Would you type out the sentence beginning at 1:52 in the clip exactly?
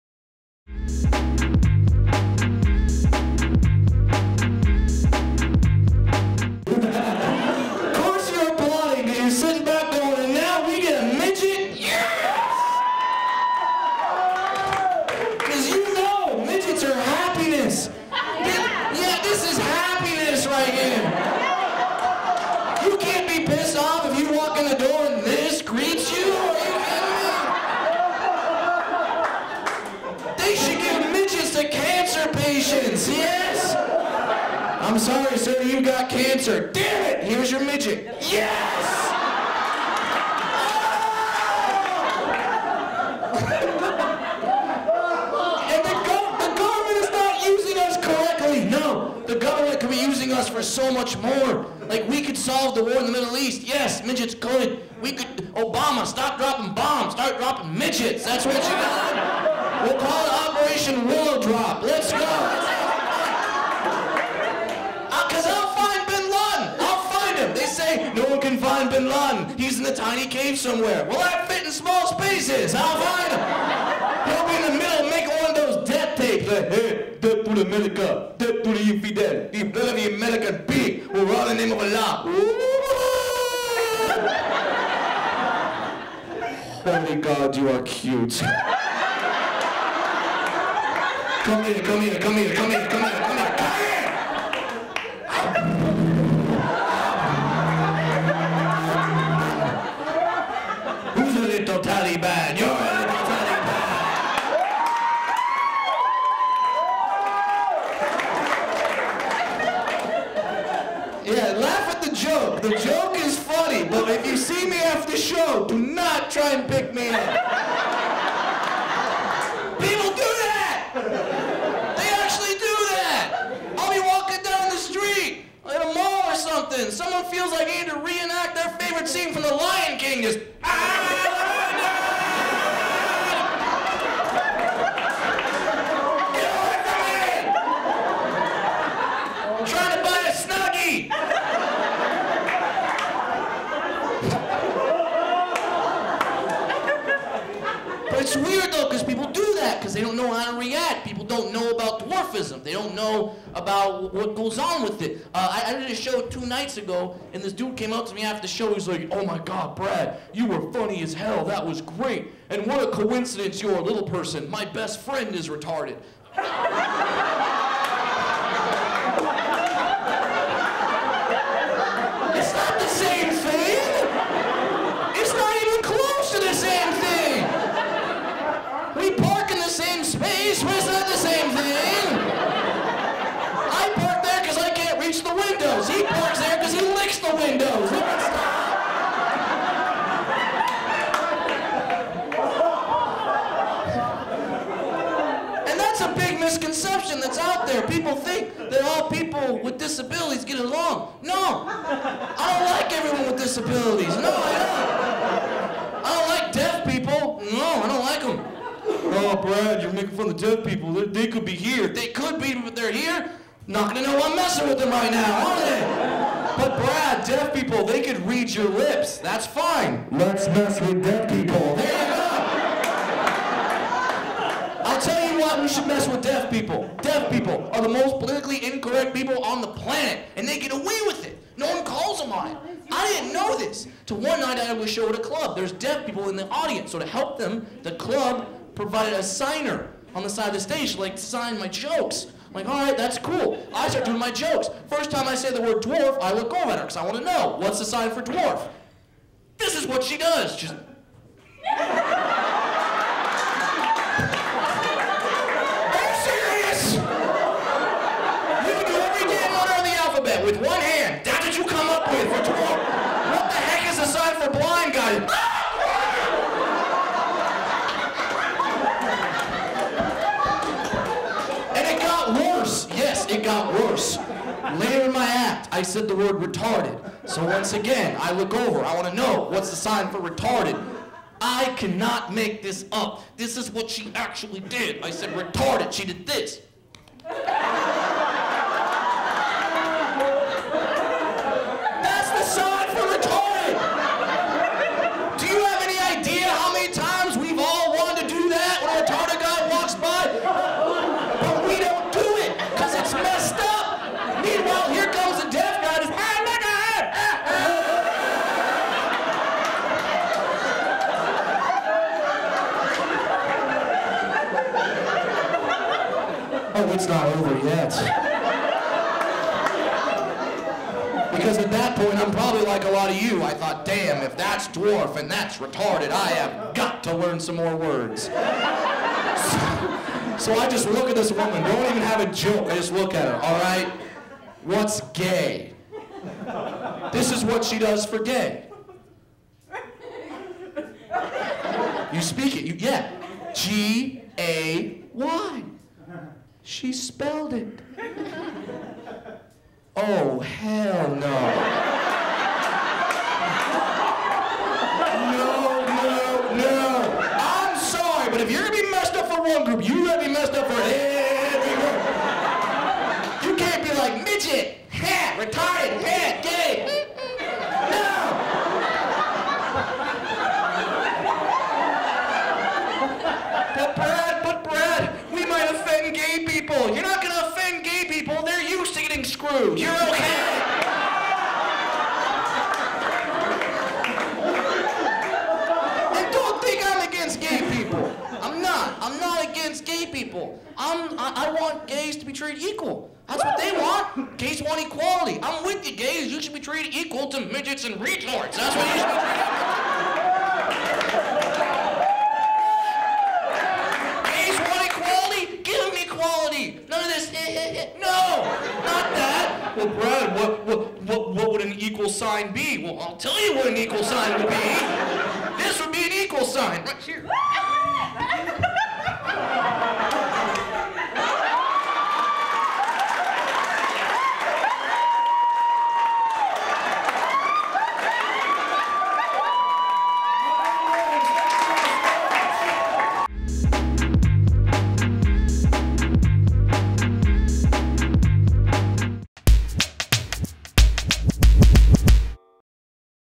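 The joke is funny, but if you see me after the show, do not try and pick me up.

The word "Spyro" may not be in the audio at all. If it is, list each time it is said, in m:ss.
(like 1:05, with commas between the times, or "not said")
not said.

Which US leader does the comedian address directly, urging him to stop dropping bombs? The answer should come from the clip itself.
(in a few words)
Obama.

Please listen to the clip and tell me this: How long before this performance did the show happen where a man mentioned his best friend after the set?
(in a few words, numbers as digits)
two nights ago.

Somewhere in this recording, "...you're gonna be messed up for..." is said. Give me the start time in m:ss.
5:58.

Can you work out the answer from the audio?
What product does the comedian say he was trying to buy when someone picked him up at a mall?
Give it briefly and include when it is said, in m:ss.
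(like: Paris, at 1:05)
Snuggie, at 2:20.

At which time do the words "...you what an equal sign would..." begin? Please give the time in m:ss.
6:53.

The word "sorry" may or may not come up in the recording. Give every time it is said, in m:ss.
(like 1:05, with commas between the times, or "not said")
0:34, 5:57.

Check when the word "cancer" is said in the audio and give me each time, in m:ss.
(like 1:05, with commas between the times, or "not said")
0:36.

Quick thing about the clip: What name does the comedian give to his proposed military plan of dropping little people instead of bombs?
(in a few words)
Operation Willow Drop.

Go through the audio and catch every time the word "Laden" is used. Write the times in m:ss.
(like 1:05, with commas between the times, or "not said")
1:09.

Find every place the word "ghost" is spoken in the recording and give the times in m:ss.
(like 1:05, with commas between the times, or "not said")
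not said.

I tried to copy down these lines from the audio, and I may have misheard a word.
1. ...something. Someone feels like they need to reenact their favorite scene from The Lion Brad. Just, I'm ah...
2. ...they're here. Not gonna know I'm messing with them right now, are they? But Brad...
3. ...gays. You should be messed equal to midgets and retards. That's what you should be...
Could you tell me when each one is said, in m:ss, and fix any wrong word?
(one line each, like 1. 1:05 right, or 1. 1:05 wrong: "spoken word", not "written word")
1. 2:06 wrong: "King", not "Brad"
2. 3:32 right
3. 6:35 wrong: "treated", not "messed".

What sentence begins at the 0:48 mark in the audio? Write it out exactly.
No, the government could be using us for so much more.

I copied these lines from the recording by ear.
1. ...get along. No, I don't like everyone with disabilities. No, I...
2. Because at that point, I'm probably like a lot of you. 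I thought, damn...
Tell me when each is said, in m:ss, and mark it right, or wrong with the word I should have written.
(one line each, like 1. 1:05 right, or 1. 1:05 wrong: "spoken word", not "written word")
1. 3:20 right
2. 5:21 right.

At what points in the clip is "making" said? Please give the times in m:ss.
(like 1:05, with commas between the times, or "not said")
1:15, 3:29.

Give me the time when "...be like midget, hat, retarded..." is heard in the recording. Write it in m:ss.
6:03.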